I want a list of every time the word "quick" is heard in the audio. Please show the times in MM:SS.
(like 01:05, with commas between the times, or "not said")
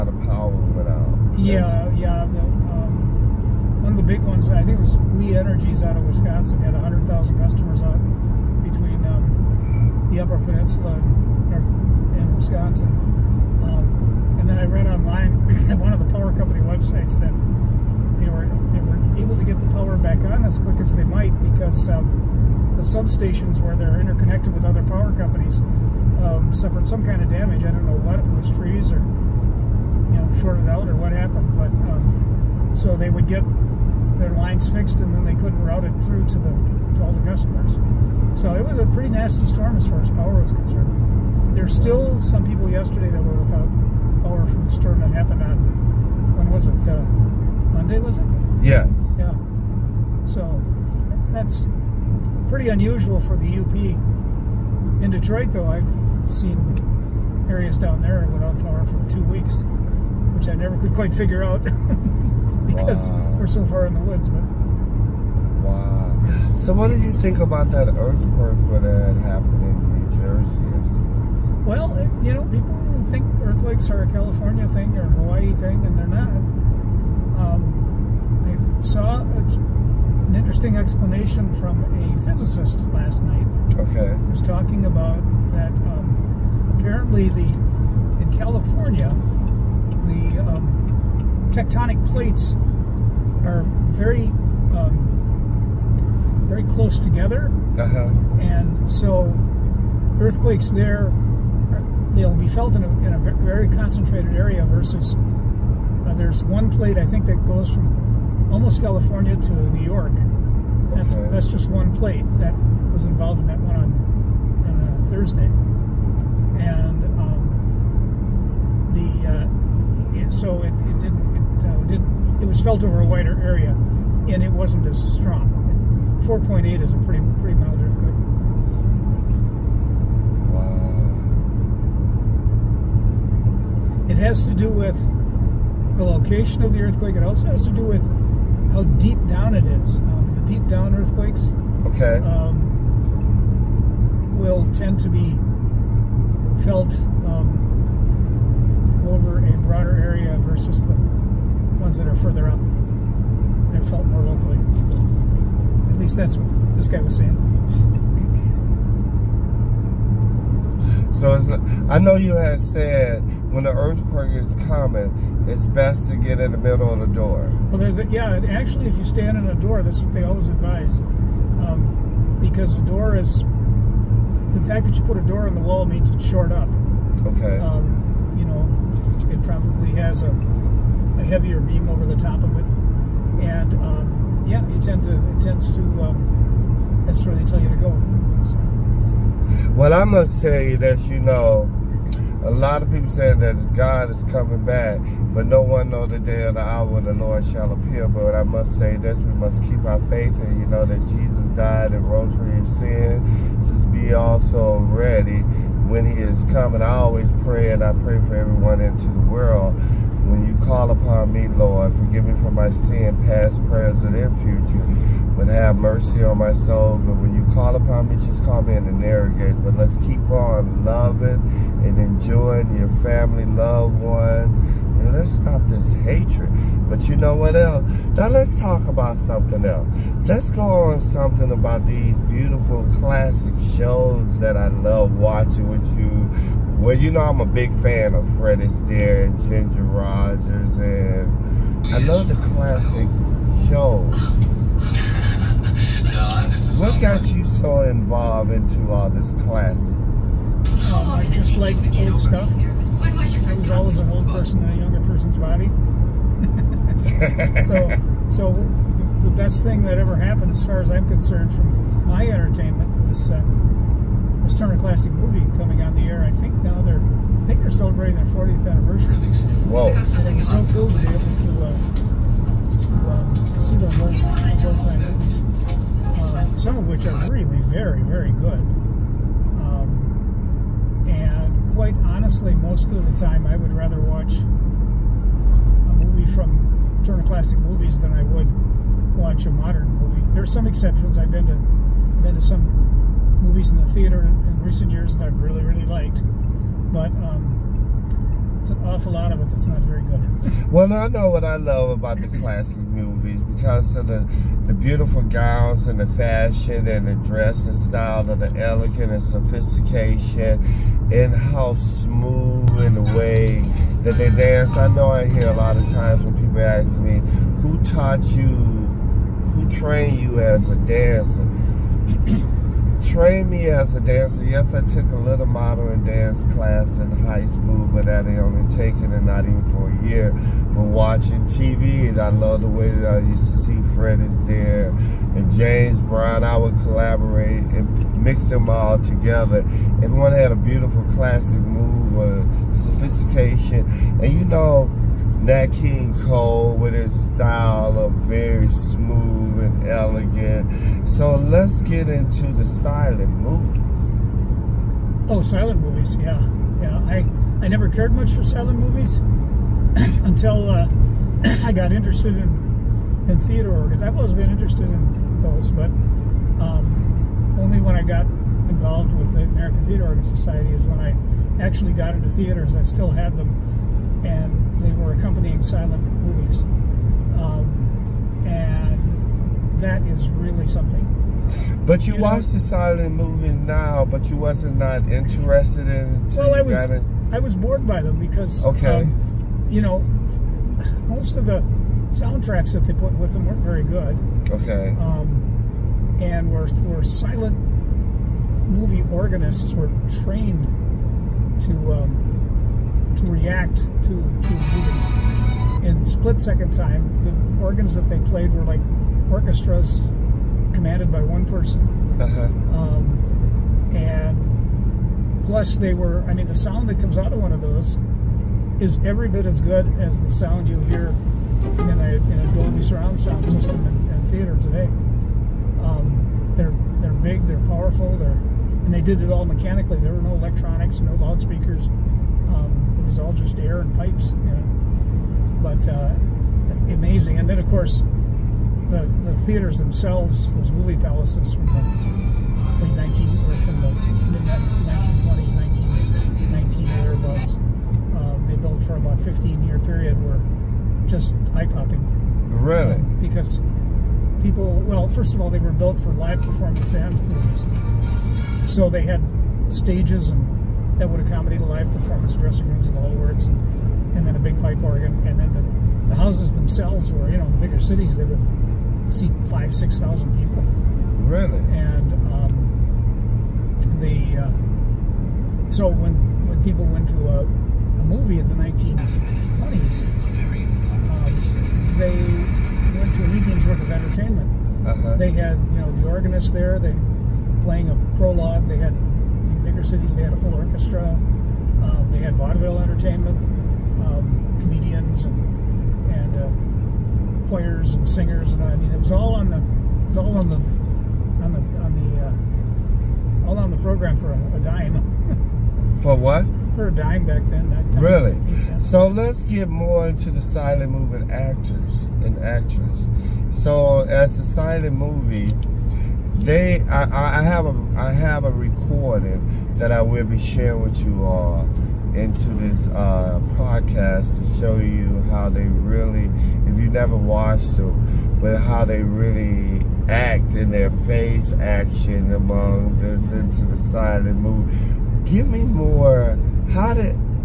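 00:20.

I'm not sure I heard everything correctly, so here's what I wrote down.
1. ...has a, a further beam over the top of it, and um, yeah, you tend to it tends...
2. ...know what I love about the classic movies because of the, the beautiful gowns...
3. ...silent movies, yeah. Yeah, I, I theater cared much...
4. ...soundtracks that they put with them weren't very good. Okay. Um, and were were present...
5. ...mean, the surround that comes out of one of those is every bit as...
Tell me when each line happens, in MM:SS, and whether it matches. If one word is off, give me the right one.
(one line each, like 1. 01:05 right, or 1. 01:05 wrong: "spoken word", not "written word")
1. 03:00 wrong: "heavier", not "further"
2. 05:01 right
3. 05:55 wrong: "never", not "theater"
4. 06:32 wrong: "silent", not "present"
5. 06:56 wrong: "sound", not "surround".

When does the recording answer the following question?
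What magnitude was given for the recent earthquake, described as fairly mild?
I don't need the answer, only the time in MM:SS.
02:06.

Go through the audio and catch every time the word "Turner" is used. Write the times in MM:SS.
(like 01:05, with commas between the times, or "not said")
04:24, 04:47.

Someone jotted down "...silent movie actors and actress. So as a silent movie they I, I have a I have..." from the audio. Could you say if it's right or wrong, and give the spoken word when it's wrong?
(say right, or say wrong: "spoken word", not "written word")
right.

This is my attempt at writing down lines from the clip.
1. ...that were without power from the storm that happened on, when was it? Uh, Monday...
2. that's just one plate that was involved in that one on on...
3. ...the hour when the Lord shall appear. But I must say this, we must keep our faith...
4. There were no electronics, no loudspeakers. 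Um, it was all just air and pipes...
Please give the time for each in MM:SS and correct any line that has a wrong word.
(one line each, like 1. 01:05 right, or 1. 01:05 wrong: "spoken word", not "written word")
1. 00:43 right
2. 01:51 right
3. 03:16 right
4. 07:09 right.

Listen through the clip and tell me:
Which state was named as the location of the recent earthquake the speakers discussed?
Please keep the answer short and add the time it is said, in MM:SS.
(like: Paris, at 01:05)
New Jersey, at 01:10.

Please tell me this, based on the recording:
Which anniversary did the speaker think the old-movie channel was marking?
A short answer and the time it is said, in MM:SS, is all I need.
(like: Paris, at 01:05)
40th, at 04:28.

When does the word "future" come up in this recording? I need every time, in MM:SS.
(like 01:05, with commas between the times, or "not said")
03:34.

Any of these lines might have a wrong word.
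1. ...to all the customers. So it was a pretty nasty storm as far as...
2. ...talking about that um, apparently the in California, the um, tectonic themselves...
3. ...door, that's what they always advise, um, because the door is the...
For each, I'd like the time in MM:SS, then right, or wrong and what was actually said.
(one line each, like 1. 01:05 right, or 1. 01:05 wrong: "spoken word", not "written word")
1. 00:36 right
2. 01:24 wrong: "plates", not "themselves"
3. 02:49 right.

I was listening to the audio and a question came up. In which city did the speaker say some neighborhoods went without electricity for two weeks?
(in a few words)
Detroit.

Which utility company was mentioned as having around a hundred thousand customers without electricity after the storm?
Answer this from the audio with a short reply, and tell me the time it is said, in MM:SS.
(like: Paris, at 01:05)
We Energies, at 00:04.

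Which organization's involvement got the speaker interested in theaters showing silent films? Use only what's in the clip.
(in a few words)
American Theater Organ Society.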